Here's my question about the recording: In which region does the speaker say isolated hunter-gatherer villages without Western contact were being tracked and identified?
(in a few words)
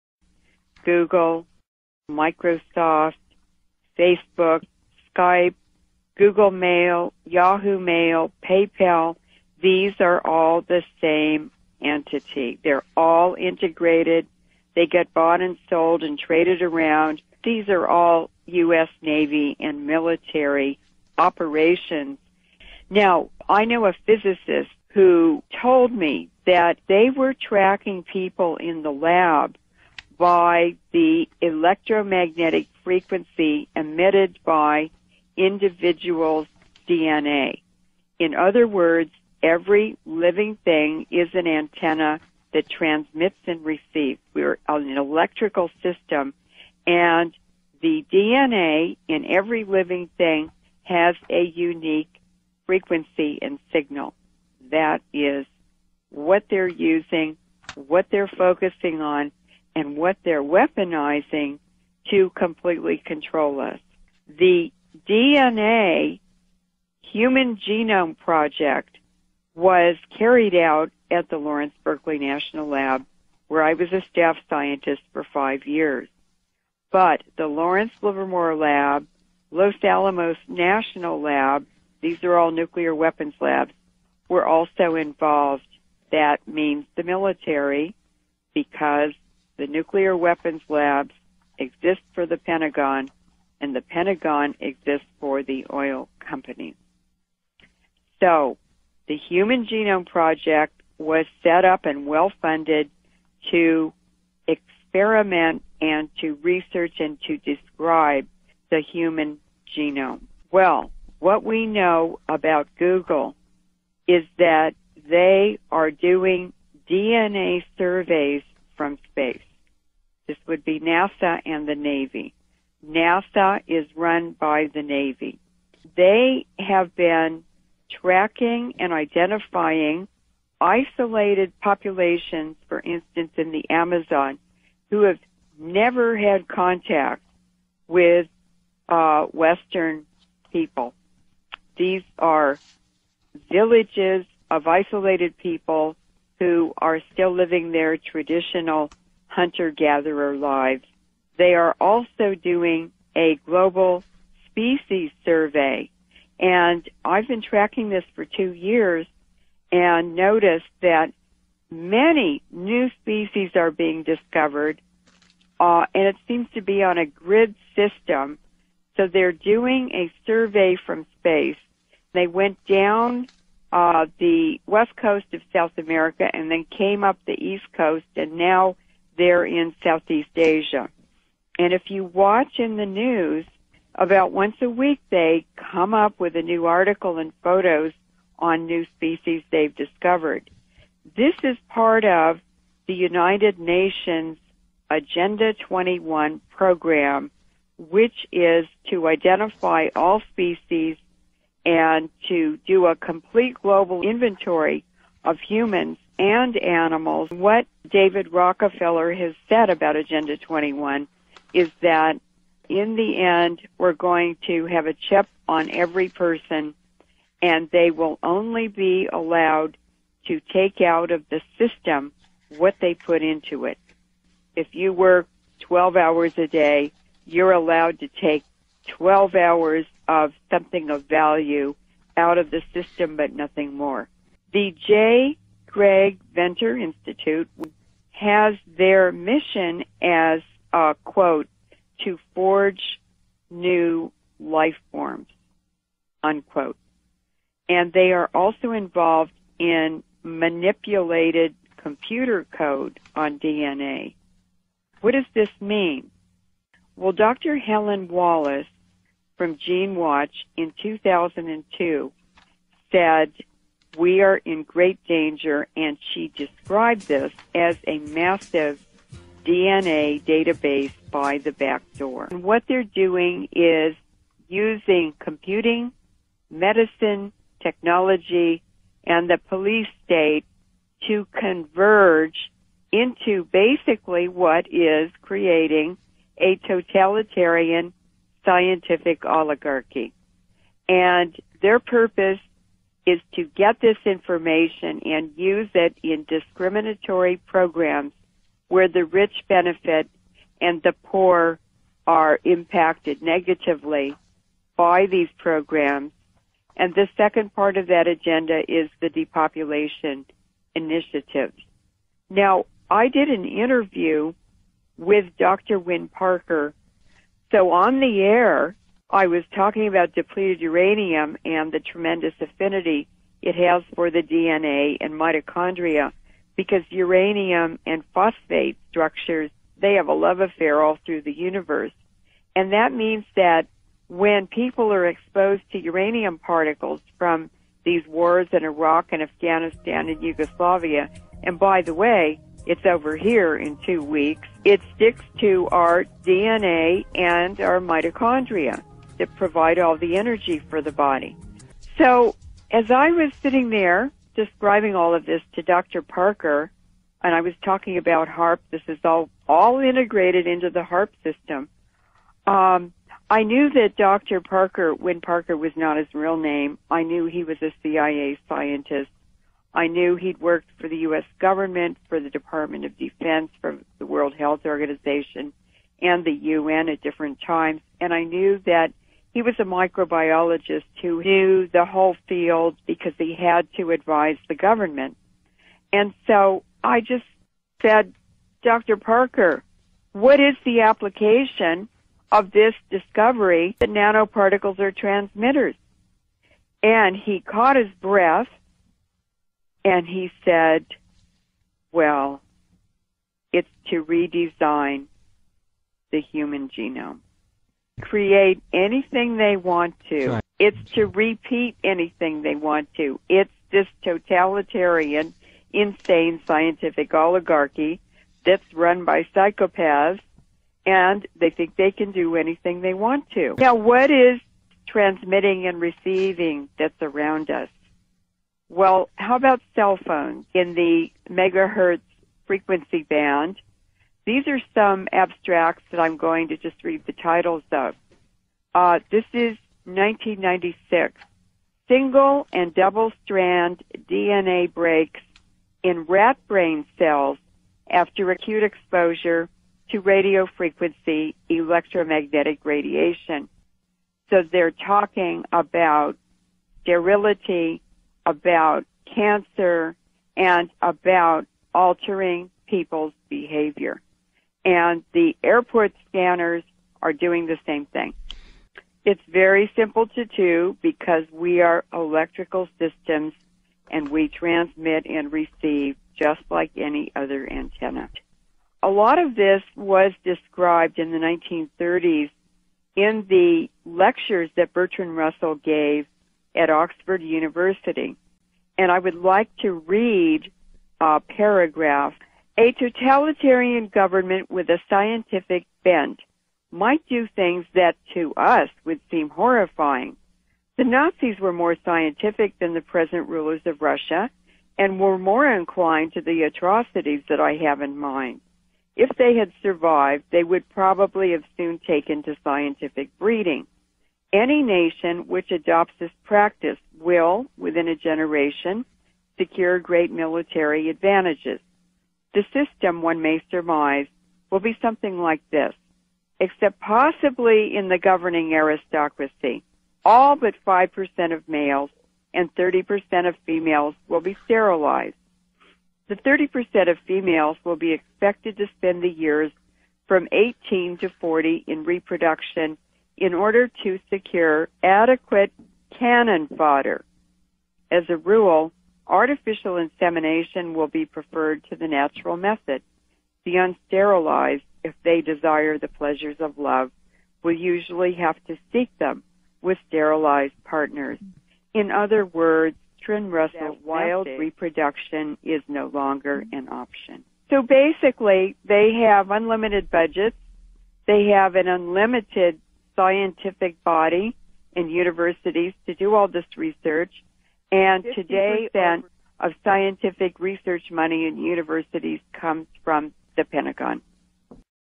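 the Amazon.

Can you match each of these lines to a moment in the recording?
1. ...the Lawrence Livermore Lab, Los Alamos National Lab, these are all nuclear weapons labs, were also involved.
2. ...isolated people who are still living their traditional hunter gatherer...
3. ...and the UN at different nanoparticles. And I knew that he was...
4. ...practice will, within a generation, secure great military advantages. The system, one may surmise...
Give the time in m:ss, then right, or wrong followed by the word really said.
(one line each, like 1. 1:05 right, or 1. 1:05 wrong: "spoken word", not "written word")
1. 1:17 right
2. 2:24 right
3. 6:16 wrong: "times", not "nanoparticles"
4. 8:36 right.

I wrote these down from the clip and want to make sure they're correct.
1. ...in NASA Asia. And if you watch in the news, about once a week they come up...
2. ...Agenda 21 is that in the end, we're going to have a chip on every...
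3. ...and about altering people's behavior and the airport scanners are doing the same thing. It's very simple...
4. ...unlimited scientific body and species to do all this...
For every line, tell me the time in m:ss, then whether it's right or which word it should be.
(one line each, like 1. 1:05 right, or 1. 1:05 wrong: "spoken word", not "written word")
1. 2:59 wrong: "Southeast", not "NASA"
2. 3:29 right
3. 7:40 right
4. 9:31 wrong: "universities", not "species".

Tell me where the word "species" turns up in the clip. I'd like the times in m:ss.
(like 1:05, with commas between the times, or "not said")
2:34, 2:43, 3:08, 3:20.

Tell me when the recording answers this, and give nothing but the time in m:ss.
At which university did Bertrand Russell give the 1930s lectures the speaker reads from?
8:06.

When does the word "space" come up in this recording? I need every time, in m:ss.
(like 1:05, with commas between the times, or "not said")
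1:59, 2:51.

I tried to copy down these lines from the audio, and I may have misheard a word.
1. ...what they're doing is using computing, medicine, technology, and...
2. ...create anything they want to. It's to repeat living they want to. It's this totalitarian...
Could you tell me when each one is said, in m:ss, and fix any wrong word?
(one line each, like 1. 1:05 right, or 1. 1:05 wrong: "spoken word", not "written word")
1. 4:32 right
2. 6:48 wrong: "anything", not "living".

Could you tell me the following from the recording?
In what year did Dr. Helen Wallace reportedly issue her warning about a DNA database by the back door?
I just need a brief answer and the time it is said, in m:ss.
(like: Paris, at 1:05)
2002, at 4:20.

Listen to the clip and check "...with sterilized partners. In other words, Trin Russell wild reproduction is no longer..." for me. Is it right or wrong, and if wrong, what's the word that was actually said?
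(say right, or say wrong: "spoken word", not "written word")
right.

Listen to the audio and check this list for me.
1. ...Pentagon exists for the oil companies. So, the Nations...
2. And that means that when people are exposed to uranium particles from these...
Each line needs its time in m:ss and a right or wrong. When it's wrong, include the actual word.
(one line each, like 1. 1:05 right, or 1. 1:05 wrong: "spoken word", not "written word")
1. 1:33 wrong: "Human", not "Nations"
2. 5:32 right.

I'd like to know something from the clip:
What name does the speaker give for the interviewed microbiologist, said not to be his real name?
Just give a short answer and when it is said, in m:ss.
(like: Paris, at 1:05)
Dr. Wynne Parker, at 5:15.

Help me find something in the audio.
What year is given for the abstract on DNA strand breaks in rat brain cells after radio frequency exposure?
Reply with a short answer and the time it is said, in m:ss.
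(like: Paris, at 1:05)
1996, at 7:19.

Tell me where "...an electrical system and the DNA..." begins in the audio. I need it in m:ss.
0:44.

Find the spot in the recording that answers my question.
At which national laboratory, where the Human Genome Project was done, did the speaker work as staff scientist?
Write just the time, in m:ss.
1:11.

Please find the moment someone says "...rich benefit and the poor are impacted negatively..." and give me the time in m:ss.
4:59.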